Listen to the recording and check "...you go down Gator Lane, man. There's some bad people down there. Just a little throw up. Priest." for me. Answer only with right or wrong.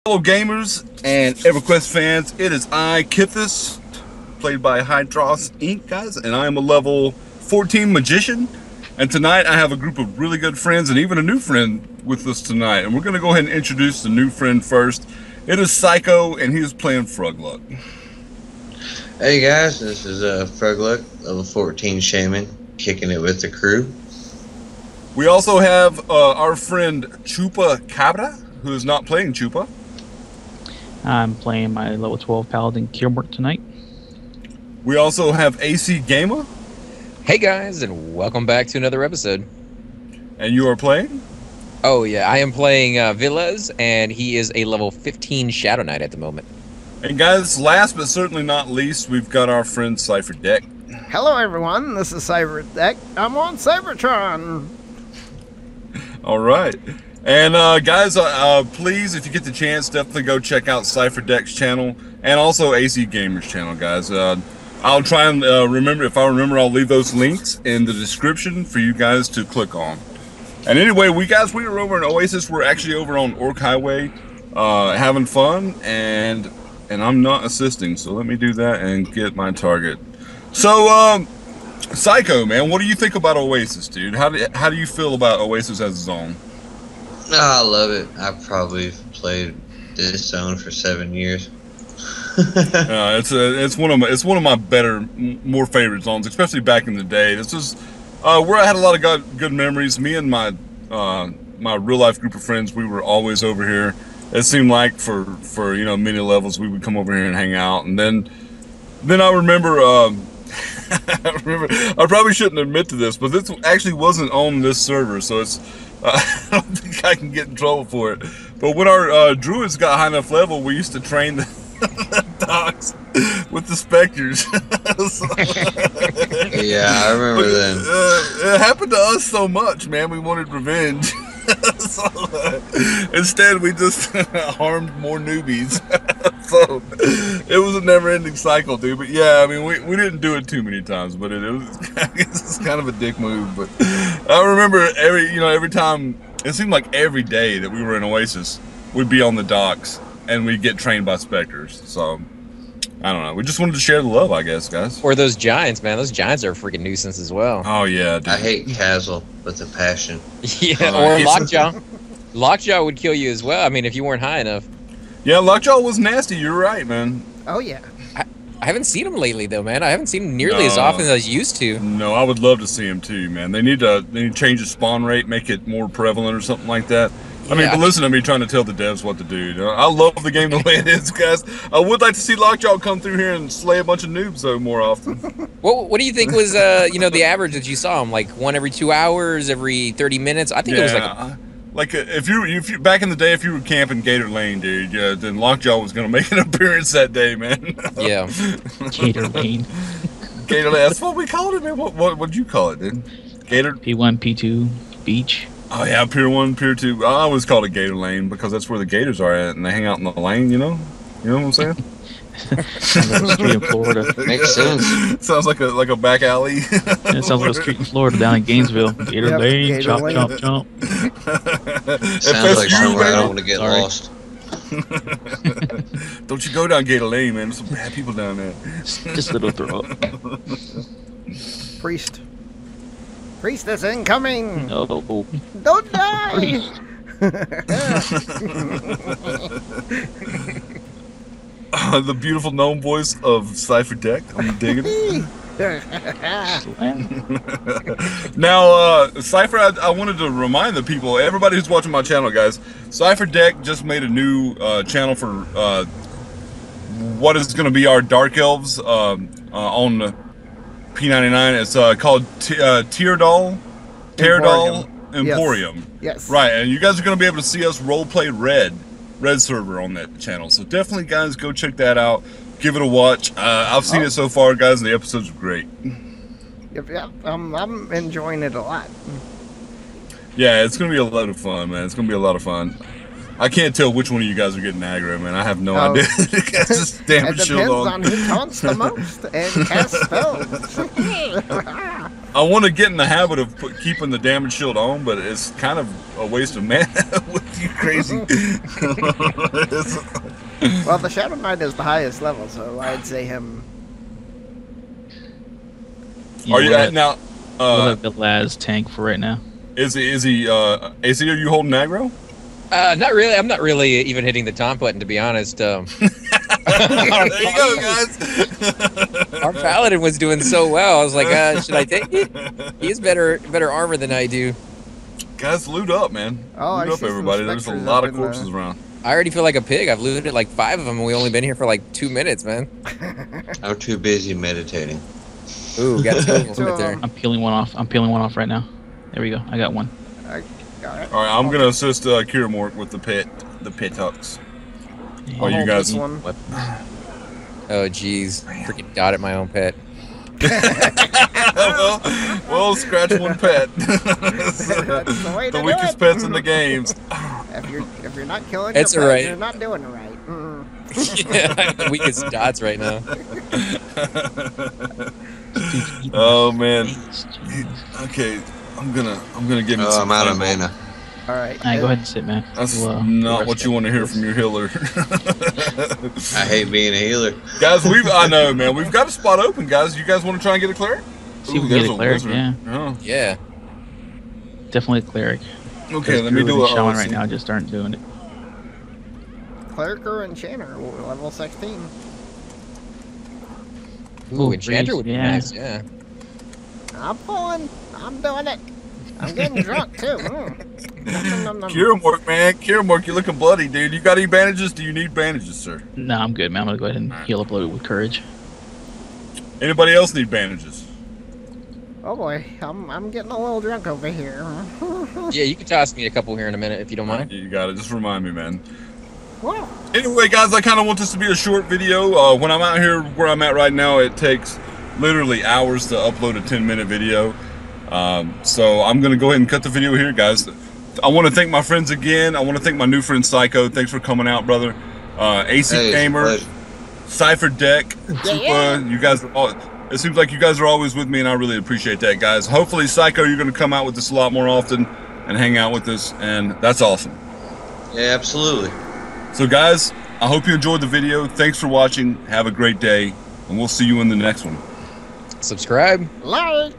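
right.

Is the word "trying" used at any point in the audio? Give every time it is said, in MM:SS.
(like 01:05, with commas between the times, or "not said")
02:58.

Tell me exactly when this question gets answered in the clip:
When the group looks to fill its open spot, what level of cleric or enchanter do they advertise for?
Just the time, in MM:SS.
06:30.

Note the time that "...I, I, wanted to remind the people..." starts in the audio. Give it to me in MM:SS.
04:09.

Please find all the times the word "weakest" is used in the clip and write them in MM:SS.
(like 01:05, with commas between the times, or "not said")
05:55, 06:01.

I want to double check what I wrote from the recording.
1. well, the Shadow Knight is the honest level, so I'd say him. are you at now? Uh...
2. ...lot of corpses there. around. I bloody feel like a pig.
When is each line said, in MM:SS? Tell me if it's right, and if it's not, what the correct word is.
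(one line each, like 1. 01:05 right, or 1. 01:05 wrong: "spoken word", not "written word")
1. 04:58 wrong: "highest", not "honest"
2. 05:27 wrong: "already", not "bloody".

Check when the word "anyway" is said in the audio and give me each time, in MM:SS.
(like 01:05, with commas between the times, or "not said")
01:10, 06:59.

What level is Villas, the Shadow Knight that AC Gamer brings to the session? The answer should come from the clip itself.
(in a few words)
15.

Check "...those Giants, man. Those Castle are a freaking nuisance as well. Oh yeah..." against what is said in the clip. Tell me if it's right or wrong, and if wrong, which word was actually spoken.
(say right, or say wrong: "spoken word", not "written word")
wrong: "Giants", not "Castle".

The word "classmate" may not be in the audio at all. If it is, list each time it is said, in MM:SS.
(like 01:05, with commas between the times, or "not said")
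not said.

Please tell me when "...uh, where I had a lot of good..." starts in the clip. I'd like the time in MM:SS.
01:38.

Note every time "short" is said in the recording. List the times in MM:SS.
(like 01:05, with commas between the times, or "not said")
07:01.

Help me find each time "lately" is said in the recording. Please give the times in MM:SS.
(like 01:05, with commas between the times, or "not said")
02:49.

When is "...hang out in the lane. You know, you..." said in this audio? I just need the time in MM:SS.
03:29.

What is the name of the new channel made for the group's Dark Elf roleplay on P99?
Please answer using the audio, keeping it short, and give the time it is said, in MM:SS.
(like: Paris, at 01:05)
Teir'Dal Emporium, at 04:22.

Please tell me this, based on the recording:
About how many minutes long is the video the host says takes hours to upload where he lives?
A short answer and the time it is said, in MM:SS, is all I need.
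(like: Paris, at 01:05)
10, at 07:06.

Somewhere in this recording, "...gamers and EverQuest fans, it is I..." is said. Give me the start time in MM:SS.
00:00.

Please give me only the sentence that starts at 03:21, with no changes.
What what would you call it, dude?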